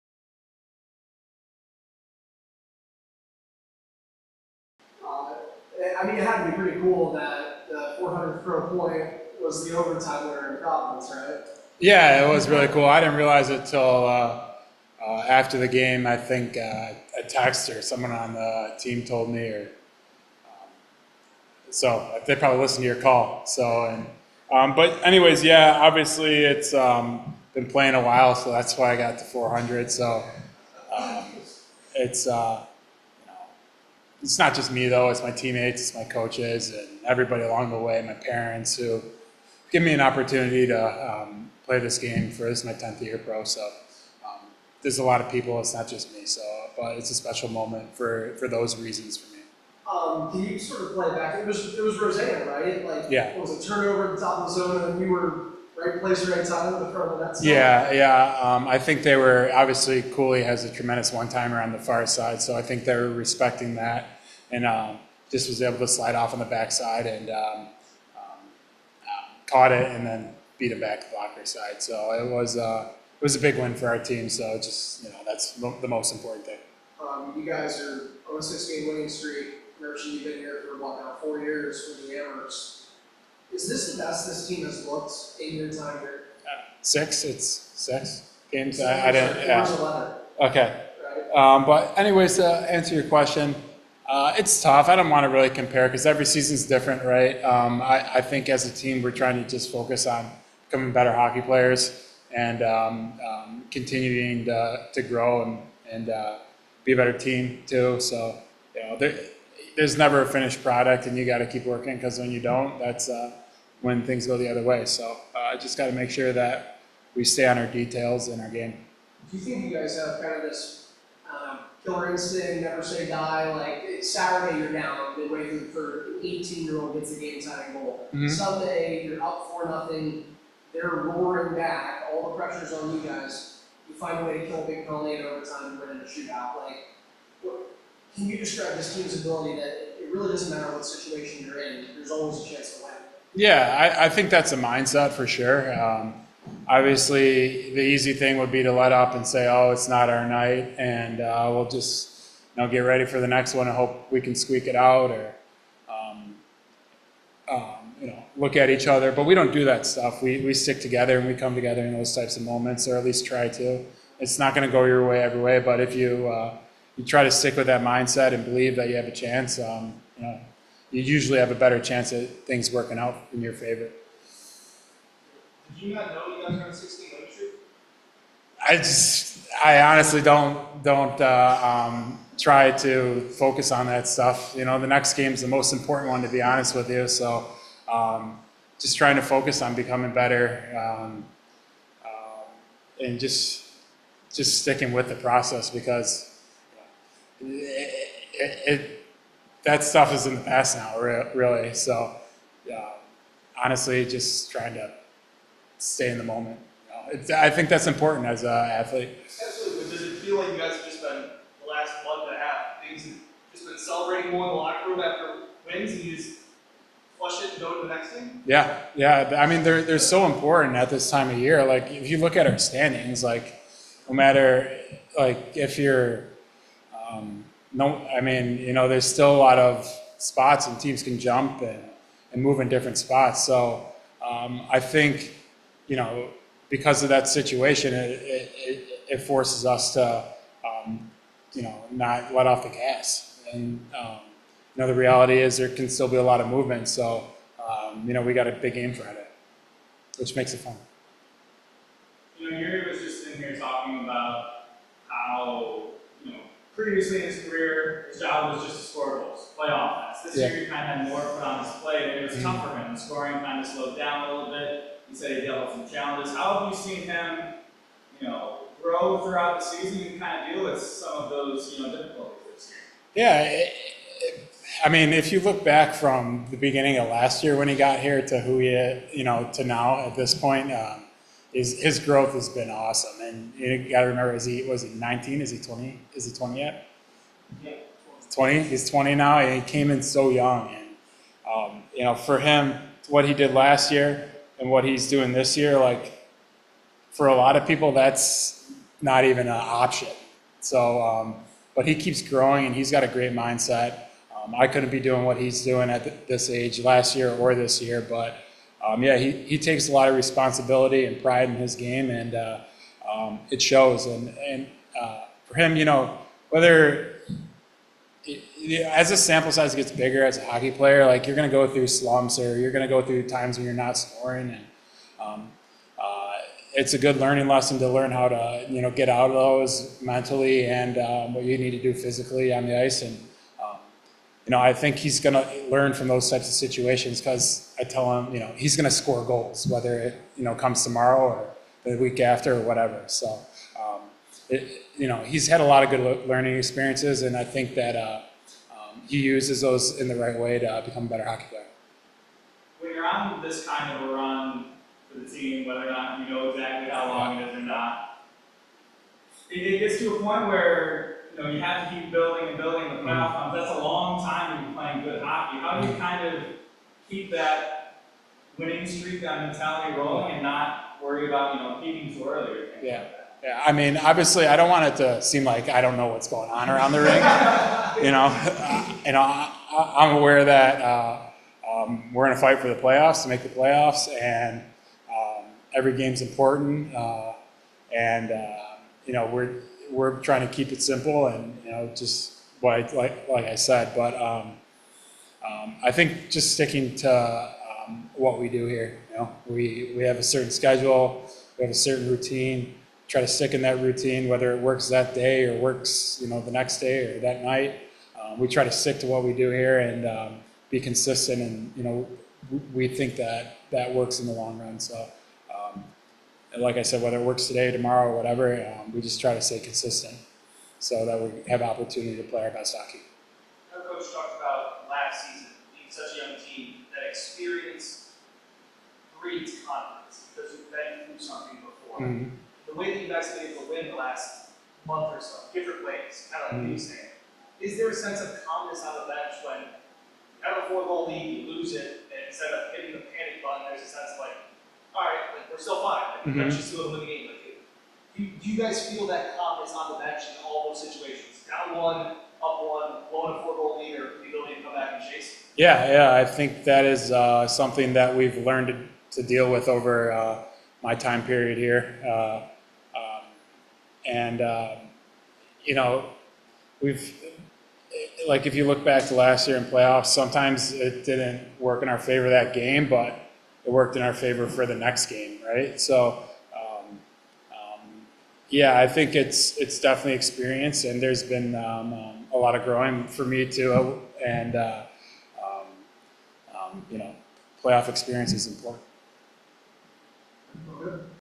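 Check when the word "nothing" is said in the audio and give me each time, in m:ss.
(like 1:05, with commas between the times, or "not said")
2:09.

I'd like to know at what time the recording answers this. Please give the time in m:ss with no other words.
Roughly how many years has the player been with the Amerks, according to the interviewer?
1:21.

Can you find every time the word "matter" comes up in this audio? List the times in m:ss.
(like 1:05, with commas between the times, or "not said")
2:20, 3:44.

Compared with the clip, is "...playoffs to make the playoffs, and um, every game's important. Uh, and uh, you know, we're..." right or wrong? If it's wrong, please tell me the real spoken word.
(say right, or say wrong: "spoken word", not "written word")
right.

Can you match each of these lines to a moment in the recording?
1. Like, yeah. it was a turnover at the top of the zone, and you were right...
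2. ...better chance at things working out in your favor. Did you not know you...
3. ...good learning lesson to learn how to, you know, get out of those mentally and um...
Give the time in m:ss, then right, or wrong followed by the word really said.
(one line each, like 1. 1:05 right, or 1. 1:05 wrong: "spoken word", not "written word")
1. 0:52 right
2. 2:51 right
3. 5:26 right.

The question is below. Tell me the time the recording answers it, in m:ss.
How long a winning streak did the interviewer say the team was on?
1:18.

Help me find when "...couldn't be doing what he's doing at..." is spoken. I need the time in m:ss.
5:04.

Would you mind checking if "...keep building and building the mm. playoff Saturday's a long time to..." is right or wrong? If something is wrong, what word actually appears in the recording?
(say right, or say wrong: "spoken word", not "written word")
wrong: "That", not "Saturday".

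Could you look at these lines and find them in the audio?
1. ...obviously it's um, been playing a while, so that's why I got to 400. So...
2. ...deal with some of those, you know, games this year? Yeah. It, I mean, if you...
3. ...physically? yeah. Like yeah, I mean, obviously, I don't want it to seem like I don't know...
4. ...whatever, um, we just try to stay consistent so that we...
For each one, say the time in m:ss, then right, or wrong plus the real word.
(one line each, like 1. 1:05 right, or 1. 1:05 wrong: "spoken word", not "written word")
1. 0:25 right
2. 4:30 wrong: "difficulties", not "games"
3. 6:12 wrong: "early", not "physically"
4. 6:58 right.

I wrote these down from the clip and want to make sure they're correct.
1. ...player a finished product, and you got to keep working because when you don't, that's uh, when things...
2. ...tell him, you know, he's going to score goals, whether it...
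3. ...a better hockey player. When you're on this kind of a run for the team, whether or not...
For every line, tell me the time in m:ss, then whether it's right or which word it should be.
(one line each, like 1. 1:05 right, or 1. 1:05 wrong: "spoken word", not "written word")
1. 1:49 wrong: "never", not "player"
2. 5:37 right
3. 5:51 right.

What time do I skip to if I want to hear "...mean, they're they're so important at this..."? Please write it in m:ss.
3:39.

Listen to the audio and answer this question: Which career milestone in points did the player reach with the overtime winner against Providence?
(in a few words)
400.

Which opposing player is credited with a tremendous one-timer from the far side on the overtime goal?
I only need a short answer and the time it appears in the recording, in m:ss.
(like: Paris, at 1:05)
Kulich, at 1:00.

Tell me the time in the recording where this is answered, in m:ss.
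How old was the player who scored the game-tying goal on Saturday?
2:06.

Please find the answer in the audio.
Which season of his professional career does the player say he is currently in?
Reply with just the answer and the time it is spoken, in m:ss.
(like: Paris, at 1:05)
10th, at 0:42.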